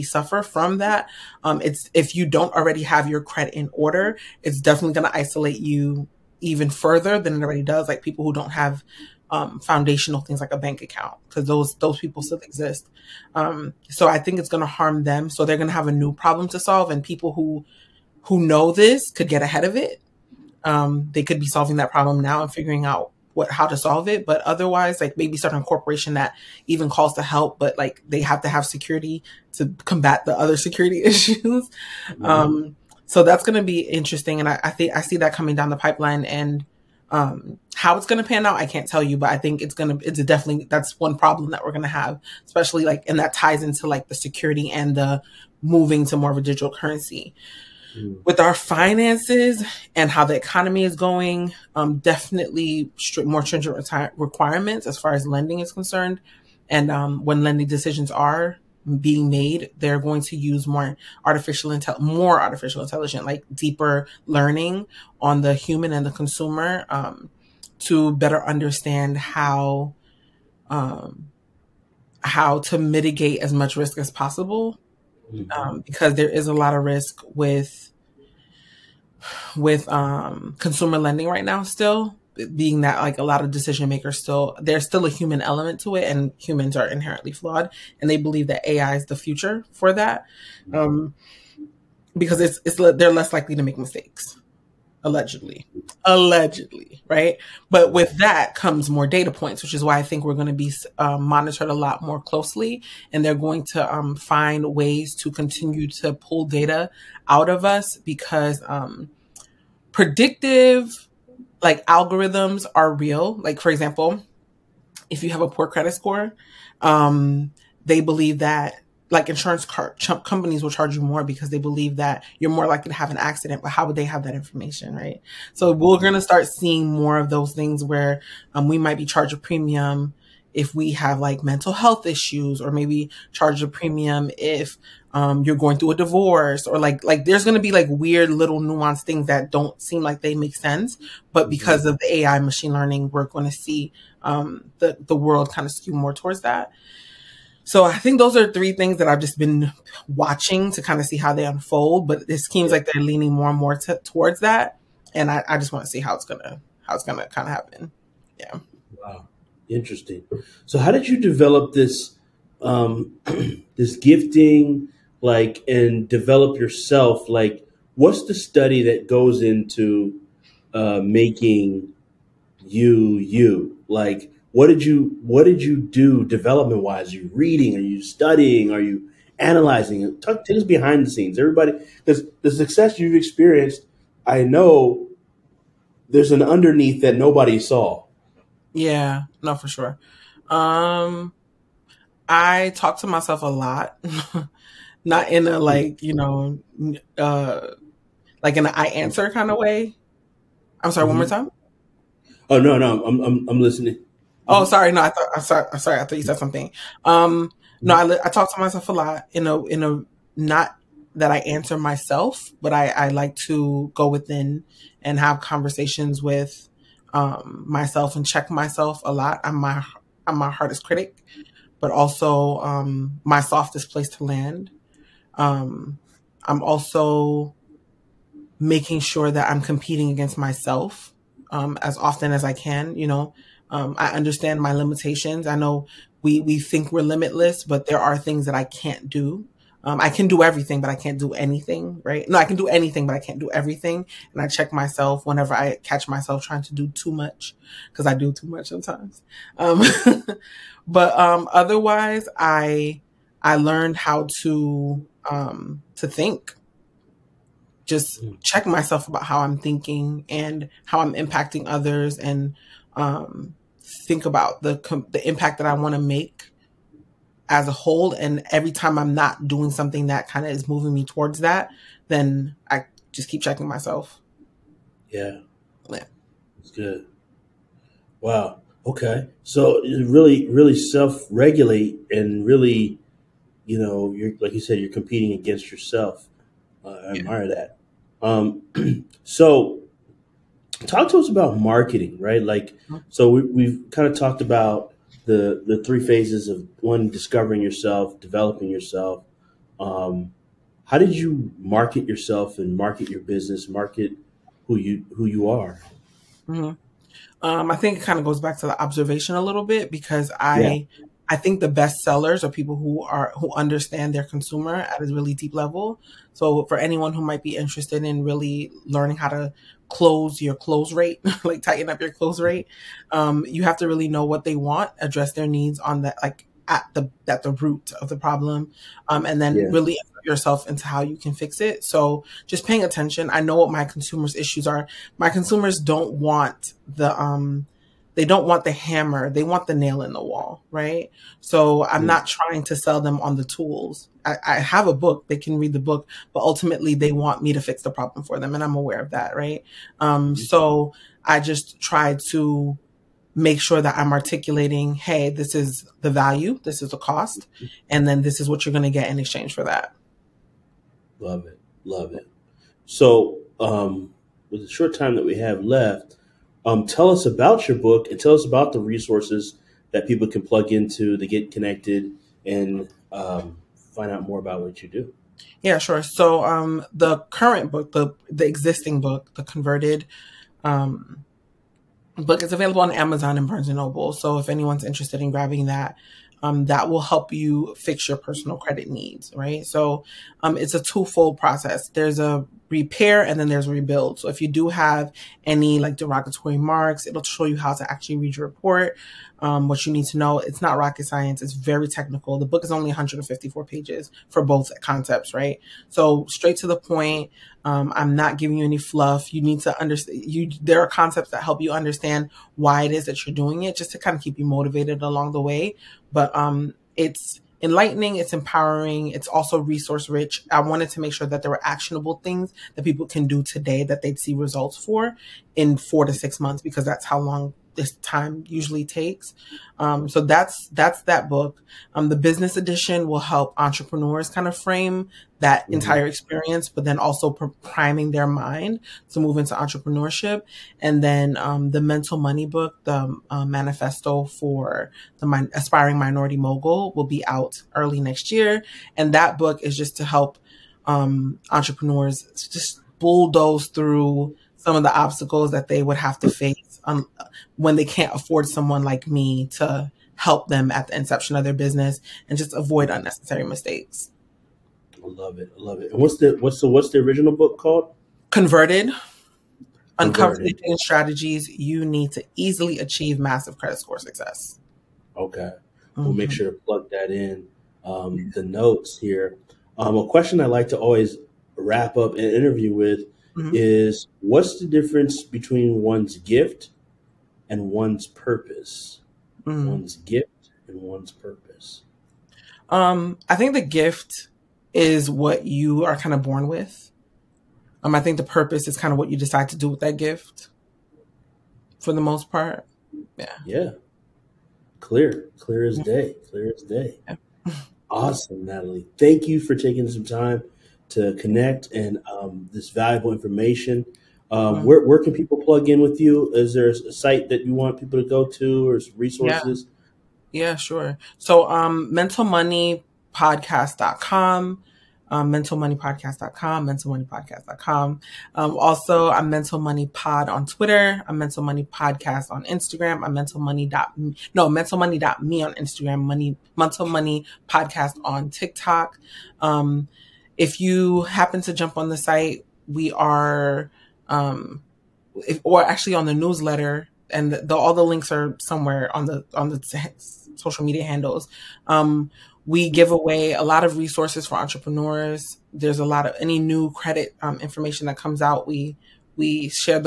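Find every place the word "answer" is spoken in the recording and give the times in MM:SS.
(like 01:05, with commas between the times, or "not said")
03:18, 03:31.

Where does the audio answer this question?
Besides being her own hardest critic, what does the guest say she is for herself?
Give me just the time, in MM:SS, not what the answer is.
03:43.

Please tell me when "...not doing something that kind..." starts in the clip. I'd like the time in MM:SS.
04:29.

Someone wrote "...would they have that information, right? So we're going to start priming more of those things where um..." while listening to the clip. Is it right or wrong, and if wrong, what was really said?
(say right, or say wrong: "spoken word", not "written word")
wrong: "seeing", not "priming".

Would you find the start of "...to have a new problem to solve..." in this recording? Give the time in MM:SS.
00:15.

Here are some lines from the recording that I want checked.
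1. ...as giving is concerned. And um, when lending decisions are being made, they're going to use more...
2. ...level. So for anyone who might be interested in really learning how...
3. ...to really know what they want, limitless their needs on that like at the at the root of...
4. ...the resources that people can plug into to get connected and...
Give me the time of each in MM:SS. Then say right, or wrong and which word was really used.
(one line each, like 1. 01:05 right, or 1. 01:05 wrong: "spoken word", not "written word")
1. 00:55 wrong: "lending", not "giving"
2. 05:15 right
3. 05:23 wrong: "address", not "limitless"
4. 06:08 right.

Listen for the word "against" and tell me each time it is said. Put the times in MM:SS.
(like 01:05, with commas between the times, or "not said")
03:50, 04:45.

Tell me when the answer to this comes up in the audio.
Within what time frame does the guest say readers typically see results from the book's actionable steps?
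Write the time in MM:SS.
07:05.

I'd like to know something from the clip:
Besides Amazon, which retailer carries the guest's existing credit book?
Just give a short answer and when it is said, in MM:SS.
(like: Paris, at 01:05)
Barnes and Noble, at 06:23.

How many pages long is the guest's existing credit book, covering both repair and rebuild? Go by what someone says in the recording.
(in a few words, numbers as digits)
154.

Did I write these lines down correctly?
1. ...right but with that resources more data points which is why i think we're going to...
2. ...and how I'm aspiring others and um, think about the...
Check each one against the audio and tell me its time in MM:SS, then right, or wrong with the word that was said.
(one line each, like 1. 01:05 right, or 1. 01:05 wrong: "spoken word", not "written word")
1. 01:37 wrong: "comes", not "resources"
2. 04:20 wrong: "impacting", not "aspiring".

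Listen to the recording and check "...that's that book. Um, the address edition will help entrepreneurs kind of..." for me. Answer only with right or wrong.
wrong.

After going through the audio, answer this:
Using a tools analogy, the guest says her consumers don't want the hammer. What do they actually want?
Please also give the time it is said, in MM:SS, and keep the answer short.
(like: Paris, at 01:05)
the nail in the wall, at 05:39.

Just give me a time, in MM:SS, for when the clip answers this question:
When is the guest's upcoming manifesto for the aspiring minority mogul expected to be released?
07:27.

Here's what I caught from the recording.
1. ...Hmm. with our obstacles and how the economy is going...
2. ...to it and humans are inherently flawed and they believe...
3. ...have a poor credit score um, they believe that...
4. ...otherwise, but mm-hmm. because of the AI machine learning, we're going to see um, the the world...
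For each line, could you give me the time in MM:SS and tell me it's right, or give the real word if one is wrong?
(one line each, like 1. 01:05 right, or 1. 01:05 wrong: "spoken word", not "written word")
1. 00:47 wrong: "finances", not "obstacles"
2. 01:25 right
3. 01:55 right
4. 02:20 wrong: "sense", not "otherwise".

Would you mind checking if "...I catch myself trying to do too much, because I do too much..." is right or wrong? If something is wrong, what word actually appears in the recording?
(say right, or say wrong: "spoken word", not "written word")
right.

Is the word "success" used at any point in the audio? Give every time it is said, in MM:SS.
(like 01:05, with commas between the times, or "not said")
03:02, 07:53.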